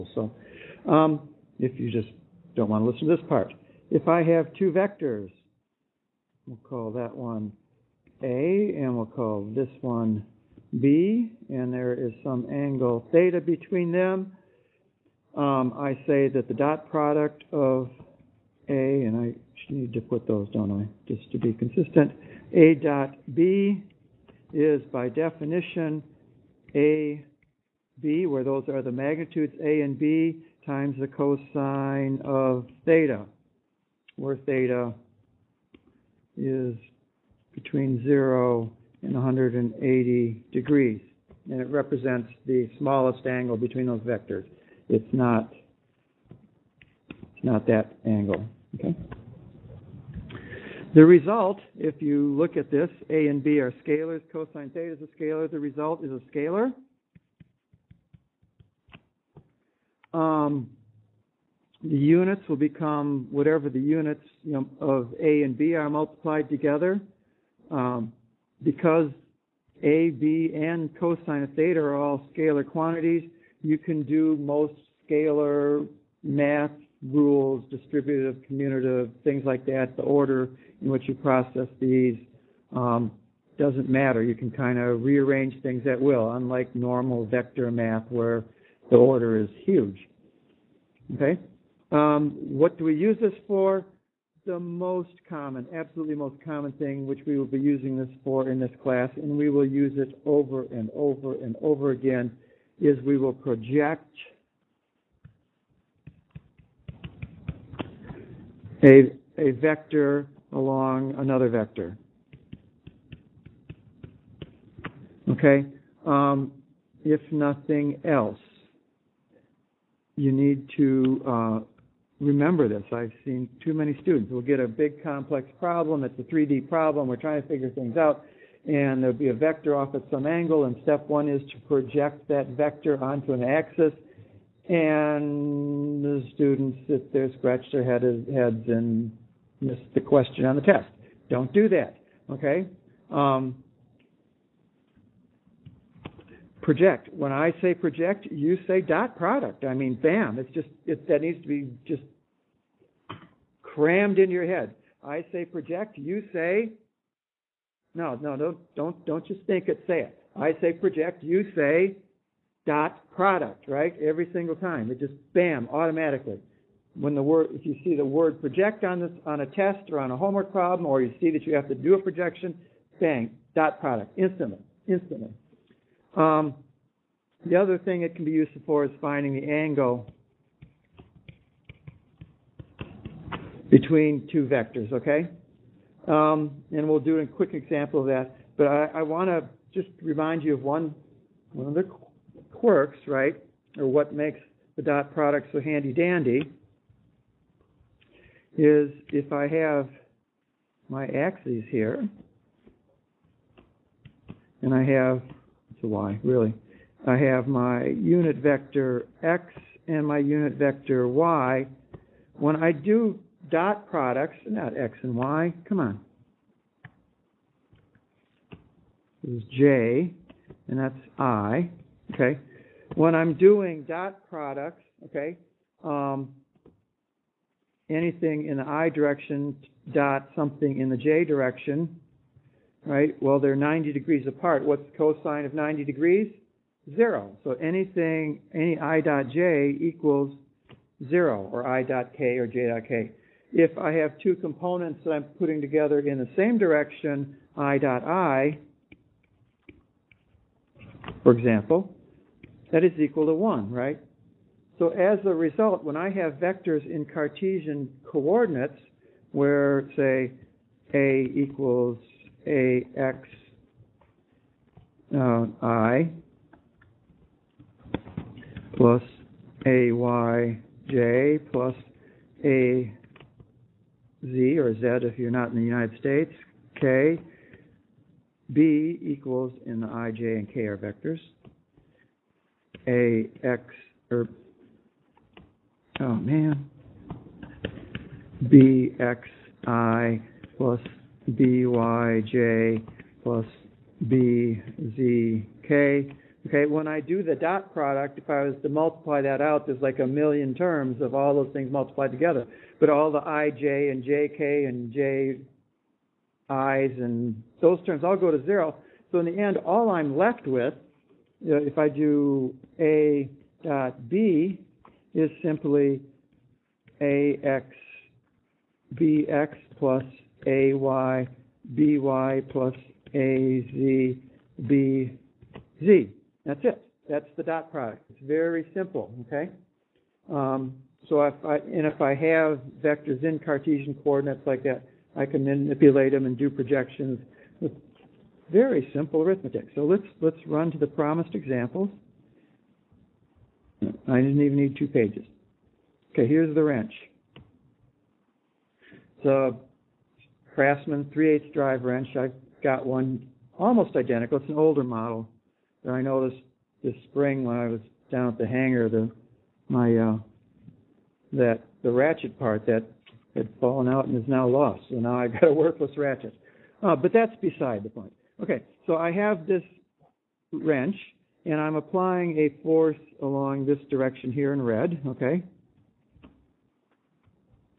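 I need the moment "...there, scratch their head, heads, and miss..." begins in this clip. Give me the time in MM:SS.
02:17.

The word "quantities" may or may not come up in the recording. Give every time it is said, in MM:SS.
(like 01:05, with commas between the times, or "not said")
01:12.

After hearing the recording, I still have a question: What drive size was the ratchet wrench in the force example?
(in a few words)
3/8.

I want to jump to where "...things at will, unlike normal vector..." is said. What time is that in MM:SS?
01:25.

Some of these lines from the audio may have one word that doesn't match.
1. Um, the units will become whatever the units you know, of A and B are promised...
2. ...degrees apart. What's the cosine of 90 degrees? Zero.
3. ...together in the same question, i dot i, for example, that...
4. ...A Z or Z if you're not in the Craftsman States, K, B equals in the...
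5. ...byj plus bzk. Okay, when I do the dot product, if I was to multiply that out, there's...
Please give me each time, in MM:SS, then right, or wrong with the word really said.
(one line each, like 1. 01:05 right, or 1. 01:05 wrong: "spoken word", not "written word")
1. 01:00 wrong: "multiplied", not "promised"
2. 03:53 right
3. 04:05 wrong: "direction", not "question"
4. 04:32 wrong: "United", not "Craftsman"
5. 04:51 right.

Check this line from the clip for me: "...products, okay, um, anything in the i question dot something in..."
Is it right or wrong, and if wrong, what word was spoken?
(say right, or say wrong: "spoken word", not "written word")
wrong: "direction", not "question".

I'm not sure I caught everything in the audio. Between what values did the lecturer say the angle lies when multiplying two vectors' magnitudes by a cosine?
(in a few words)
0 and 180 degrees.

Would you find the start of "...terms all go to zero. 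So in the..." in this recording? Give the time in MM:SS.
05:07.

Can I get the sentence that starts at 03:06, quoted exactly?
Um, and we'll do a quick example of that.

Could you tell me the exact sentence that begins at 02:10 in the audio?
And step one is to project that vector onto an axis.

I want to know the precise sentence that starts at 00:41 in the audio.
And it represents the smallest angle between those vectors.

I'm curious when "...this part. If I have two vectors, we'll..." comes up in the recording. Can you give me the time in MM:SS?
00:03.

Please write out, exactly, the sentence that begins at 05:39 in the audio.
So let's let's run to the promised examples.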